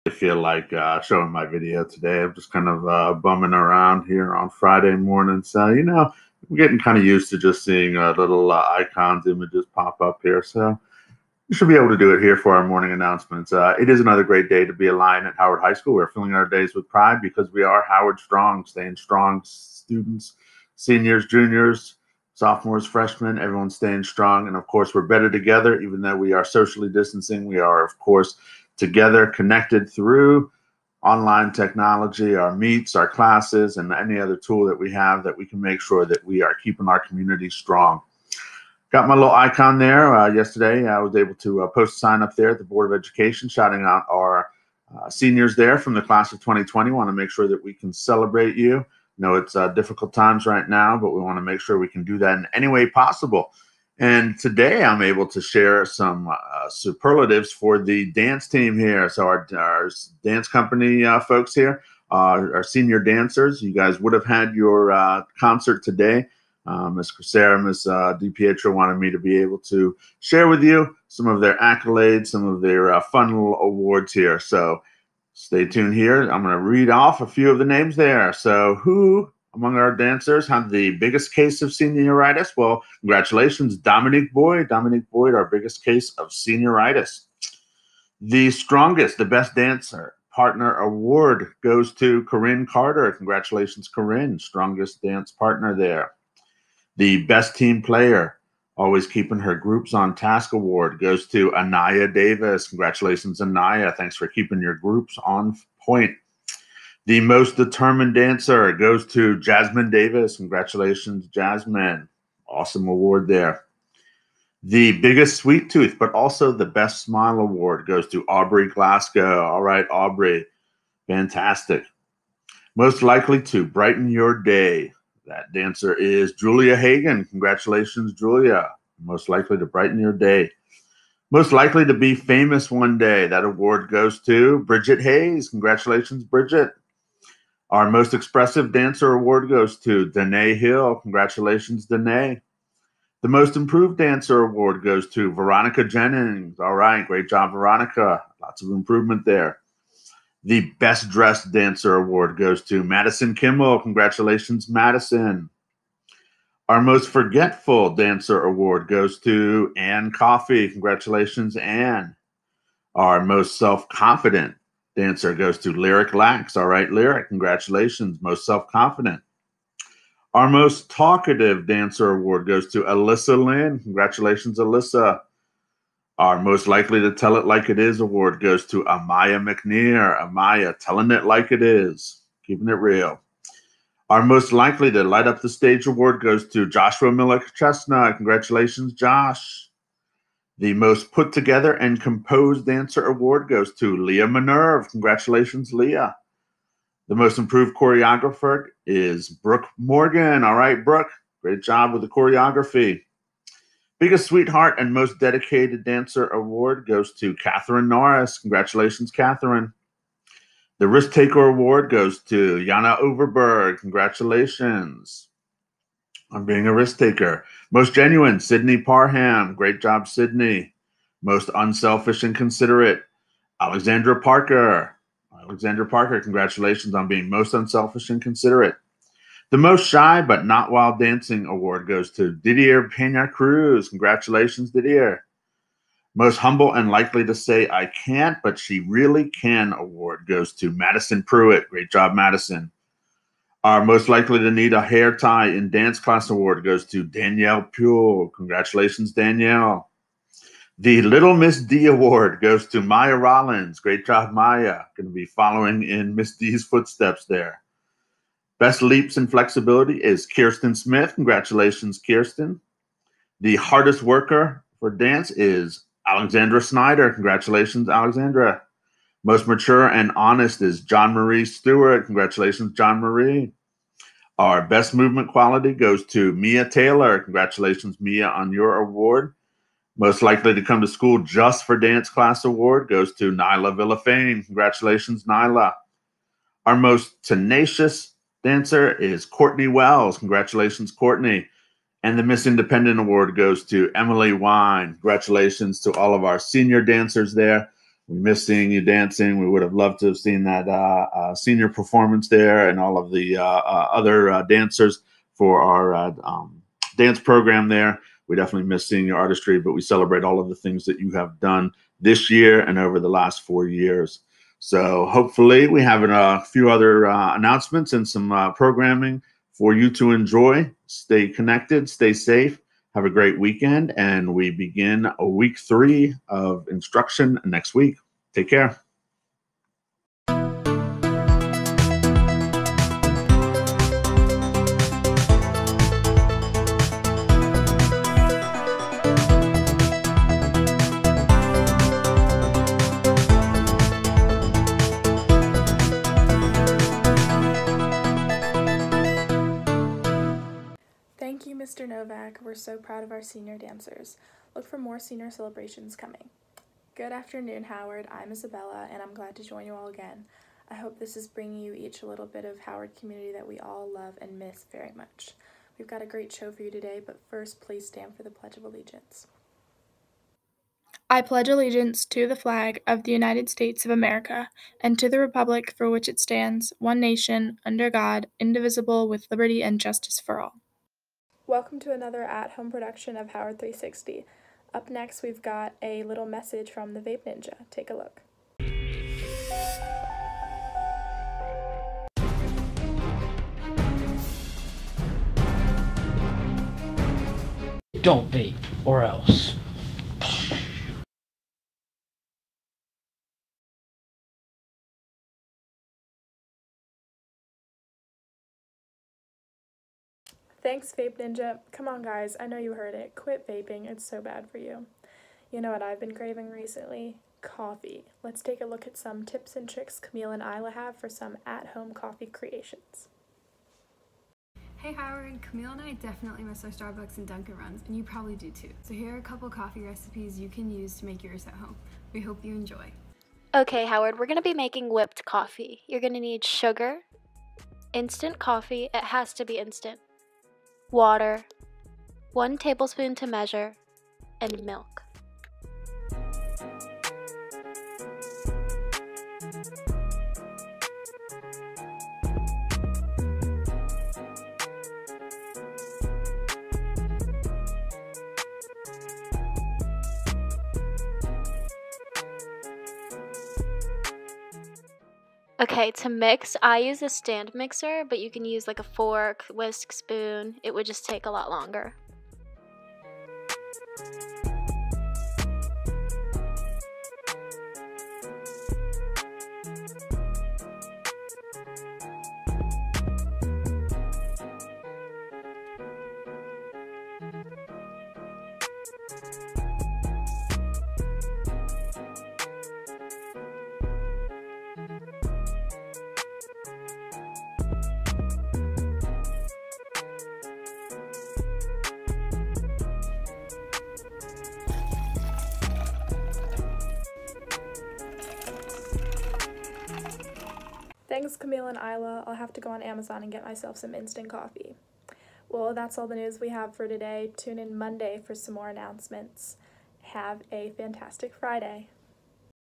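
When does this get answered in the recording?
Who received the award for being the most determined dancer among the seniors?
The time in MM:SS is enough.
01:49.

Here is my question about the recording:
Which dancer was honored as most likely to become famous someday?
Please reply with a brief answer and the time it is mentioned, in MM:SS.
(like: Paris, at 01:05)
Bridget Hayes, at 02:14.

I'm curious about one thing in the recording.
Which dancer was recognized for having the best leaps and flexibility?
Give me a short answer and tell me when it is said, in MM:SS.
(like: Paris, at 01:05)
Kirsten Smith, at 04:20.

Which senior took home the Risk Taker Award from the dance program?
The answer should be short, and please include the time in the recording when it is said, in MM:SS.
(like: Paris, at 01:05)
Jana Overberg, at 03:32.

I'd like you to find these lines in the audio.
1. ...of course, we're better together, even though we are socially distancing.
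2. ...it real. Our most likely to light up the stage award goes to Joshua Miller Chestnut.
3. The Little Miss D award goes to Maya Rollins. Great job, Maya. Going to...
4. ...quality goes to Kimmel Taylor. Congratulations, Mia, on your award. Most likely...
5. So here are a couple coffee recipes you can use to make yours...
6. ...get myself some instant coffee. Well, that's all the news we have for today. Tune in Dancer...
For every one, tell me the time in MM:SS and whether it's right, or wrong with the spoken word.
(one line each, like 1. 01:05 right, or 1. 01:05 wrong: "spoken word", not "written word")
1. 00:24 right
2. 03:02 right
3. 04:10 right
4. 04:35 wrong: "Mia", not "Kimmel"
5. 07:08 right
6. 08:33 wrong: "Monday", not "Dancer".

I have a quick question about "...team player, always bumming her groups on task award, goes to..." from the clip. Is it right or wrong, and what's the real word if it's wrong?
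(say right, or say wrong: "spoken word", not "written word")
wrong: "keeping", not "bumming".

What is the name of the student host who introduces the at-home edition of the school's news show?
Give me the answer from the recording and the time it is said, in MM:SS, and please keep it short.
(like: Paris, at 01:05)
Isabella, at 05:58.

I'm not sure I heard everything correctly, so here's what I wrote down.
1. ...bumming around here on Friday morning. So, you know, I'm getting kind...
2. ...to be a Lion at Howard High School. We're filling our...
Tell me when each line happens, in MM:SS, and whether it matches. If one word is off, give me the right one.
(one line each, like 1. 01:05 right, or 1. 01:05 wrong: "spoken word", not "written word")
1. 00:03 right
2. 00:14 right.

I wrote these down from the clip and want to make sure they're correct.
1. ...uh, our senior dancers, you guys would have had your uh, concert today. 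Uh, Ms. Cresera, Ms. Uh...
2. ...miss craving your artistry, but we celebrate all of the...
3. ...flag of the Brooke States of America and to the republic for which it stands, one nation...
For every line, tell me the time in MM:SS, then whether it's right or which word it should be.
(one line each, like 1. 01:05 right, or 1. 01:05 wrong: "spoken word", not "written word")
1. 01:02 right
2. 05:08 wrong: "seeing", not "craving"
3. 06:12 wrong: "United", not "Brooke".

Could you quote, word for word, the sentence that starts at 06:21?
Welcome to another at-home production of Howard 360.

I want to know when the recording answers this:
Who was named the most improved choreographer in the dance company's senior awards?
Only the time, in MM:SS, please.
03:19.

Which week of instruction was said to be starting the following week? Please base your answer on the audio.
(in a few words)
week three.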